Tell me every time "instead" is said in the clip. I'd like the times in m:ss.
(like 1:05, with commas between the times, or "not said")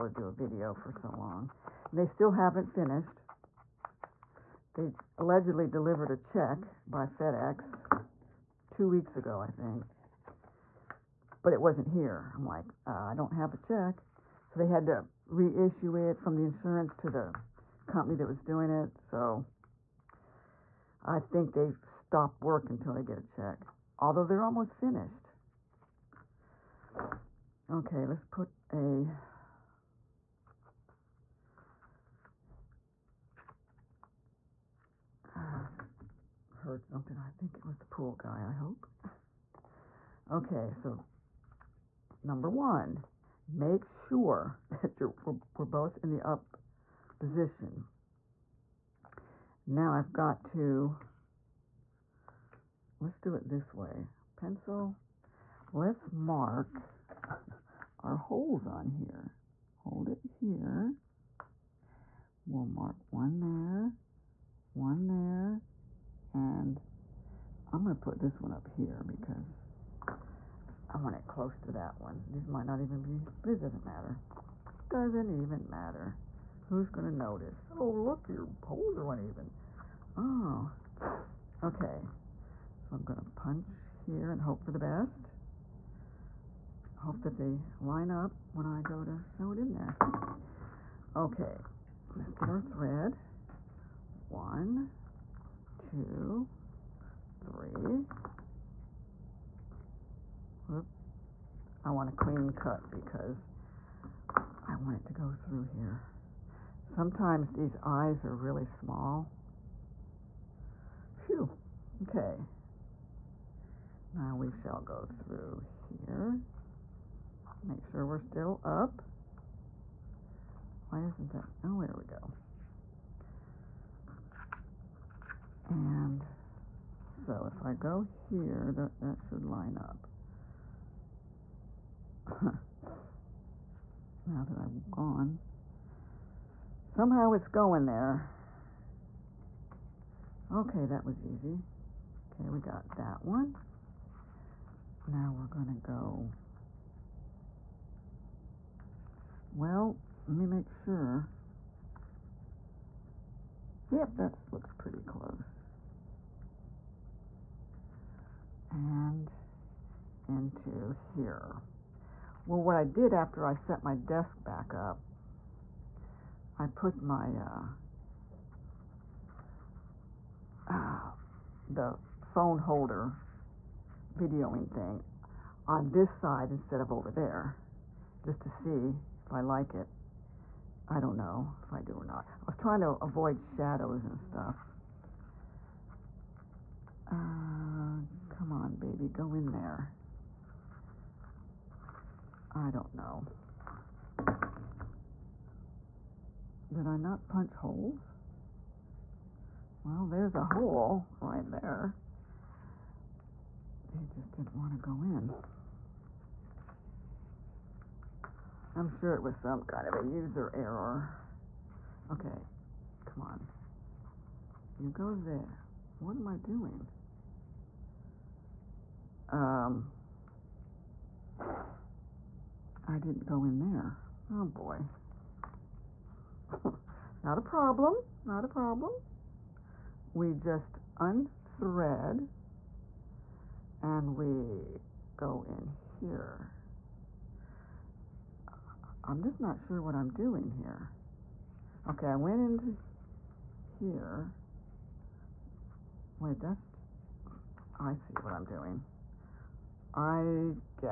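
2:56.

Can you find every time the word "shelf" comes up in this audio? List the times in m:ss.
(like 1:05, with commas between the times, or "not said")
not said.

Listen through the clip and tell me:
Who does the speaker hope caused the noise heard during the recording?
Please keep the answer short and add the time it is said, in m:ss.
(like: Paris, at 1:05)
The pool guy, at 0:37.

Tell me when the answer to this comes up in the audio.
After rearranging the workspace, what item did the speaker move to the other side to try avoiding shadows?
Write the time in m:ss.
2:52.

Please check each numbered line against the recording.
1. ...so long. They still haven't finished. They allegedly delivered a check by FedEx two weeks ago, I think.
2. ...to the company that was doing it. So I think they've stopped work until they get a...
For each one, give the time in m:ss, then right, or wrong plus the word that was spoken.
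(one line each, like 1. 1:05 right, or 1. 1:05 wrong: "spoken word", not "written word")
1. 0:00 right
2. 0:16 right.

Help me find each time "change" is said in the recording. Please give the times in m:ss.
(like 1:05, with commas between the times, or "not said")
not said.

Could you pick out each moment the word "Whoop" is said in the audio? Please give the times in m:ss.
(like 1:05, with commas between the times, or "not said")
1:40.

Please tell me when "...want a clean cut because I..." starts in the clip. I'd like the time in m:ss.
1:41.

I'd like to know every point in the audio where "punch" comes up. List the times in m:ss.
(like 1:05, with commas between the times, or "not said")
1:23, 3:17.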